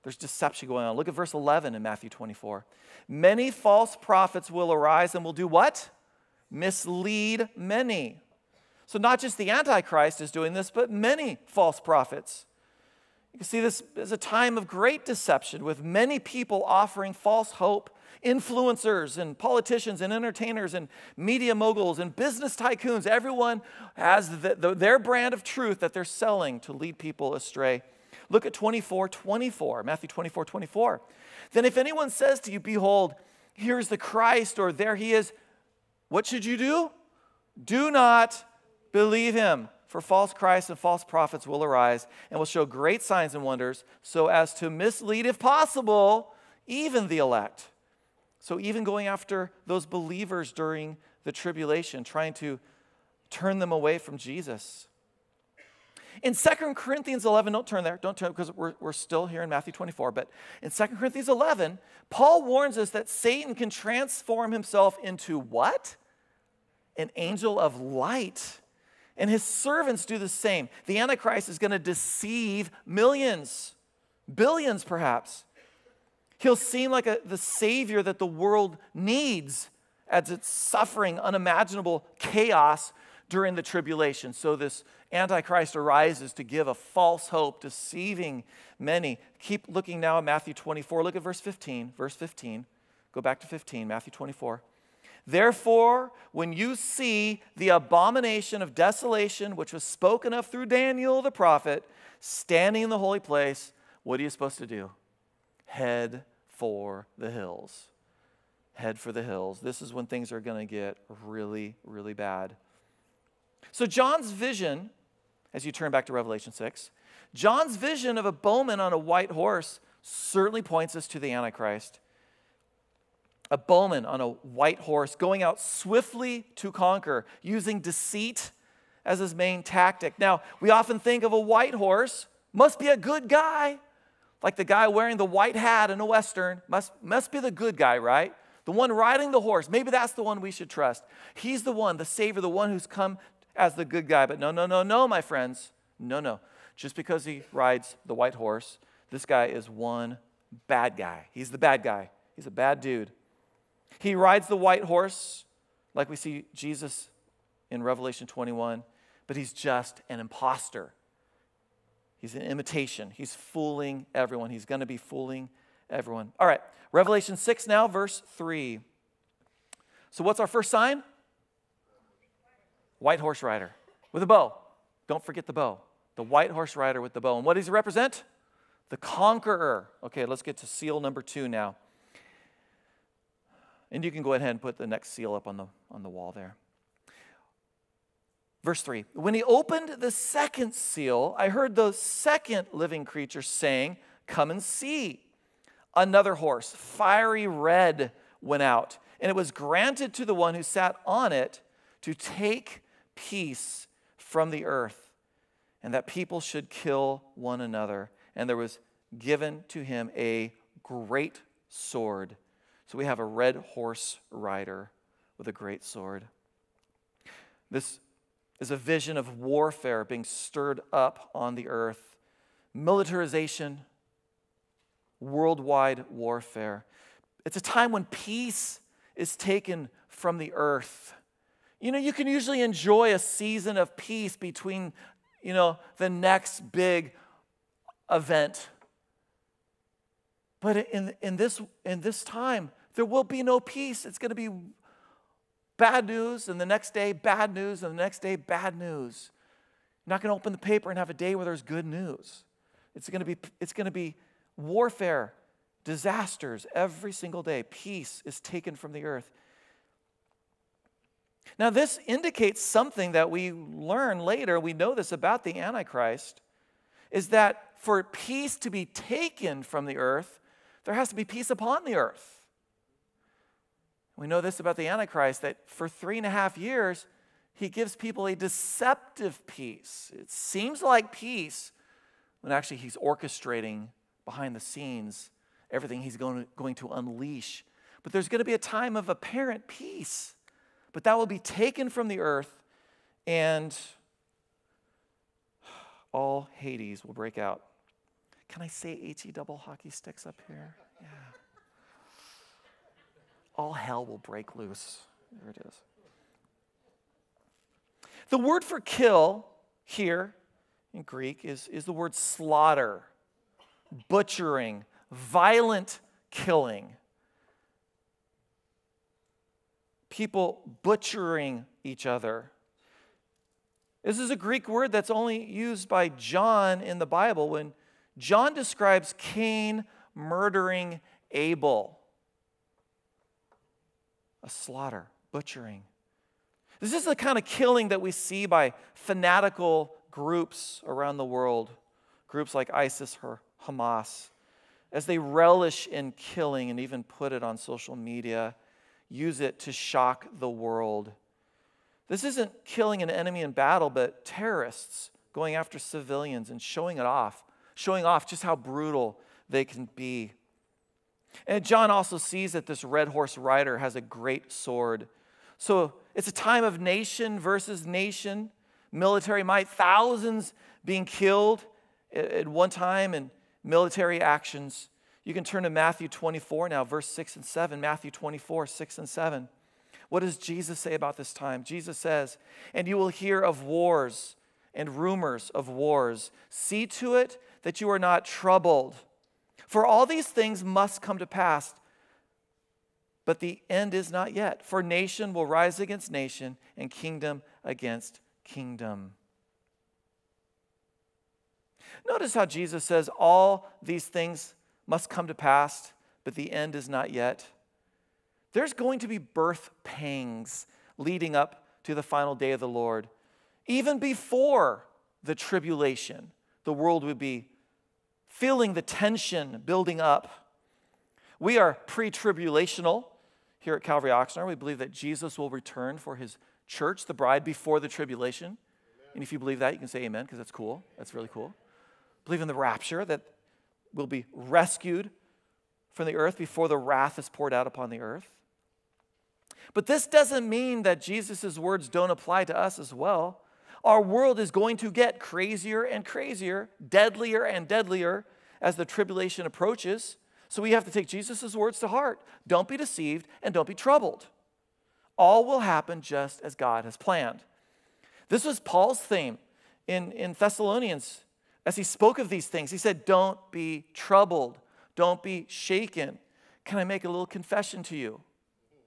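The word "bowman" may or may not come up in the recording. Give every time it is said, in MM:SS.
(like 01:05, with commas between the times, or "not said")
01:58, 02:03.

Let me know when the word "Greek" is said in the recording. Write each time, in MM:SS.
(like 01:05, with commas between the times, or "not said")
05:11, 05:24.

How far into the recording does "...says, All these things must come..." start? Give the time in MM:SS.
06:42.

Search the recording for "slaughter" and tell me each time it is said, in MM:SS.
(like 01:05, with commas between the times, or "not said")
05:12, 05:34.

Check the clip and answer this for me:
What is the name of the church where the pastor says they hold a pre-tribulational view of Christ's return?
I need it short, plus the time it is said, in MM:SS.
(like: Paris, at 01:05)
Calvary Oxnard, at 07:03.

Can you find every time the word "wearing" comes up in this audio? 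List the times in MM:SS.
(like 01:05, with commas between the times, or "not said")
02:14.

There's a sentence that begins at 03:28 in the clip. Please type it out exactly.
And there was given to him a great sword.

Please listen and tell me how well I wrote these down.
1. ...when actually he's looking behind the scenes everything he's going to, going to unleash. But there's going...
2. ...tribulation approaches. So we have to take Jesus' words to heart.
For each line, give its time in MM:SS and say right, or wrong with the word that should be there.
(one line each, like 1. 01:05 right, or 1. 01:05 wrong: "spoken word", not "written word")
1. 04:42 wrong: "orchestrating", not "looking"
2. 07:28 right.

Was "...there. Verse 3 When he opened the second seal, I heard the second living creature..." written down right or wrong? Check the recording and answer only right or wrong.
right.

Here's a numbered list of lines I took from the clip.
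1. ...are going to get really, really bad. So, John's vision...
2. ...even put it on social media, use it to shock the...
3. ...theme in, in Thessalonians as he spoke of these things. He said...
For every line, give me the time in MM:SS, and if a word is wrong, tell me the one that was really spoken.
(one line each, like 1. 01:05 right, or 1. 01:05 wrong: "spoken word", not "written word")
1. 01:50 right
2. 05:46 right
3. 07:39 right.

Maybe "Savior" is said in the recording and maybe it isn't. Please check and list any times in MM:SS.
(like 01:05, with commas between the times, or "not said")
01:17, 02:22.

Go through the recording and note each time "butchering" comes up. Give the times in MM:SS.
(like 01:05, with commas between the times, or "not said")
05:14, 05:20, 05:35.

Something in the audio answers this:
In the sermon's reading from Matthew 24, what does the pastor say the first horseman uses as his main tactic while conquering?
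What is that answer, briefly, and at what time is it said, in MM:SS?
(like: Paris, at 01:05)
Deceit, at 02:07.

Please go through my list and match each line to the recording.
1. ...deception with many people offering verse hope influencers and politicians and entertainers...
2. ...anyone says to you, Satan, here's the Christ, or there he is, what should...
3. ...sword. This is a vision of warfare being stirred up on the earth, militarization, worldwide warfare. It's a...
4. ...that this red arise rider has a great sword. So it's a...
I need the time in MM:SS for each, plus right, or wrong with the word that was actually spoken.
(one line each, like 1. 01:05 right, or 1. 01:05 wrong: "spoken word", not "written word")
1. 00:15 wrong: "false", not "verse"
2. 00:31 wrong: "Behold", not "Satan"
3. 03:35 right
4. 06:02 wrong: "horse", not "arise".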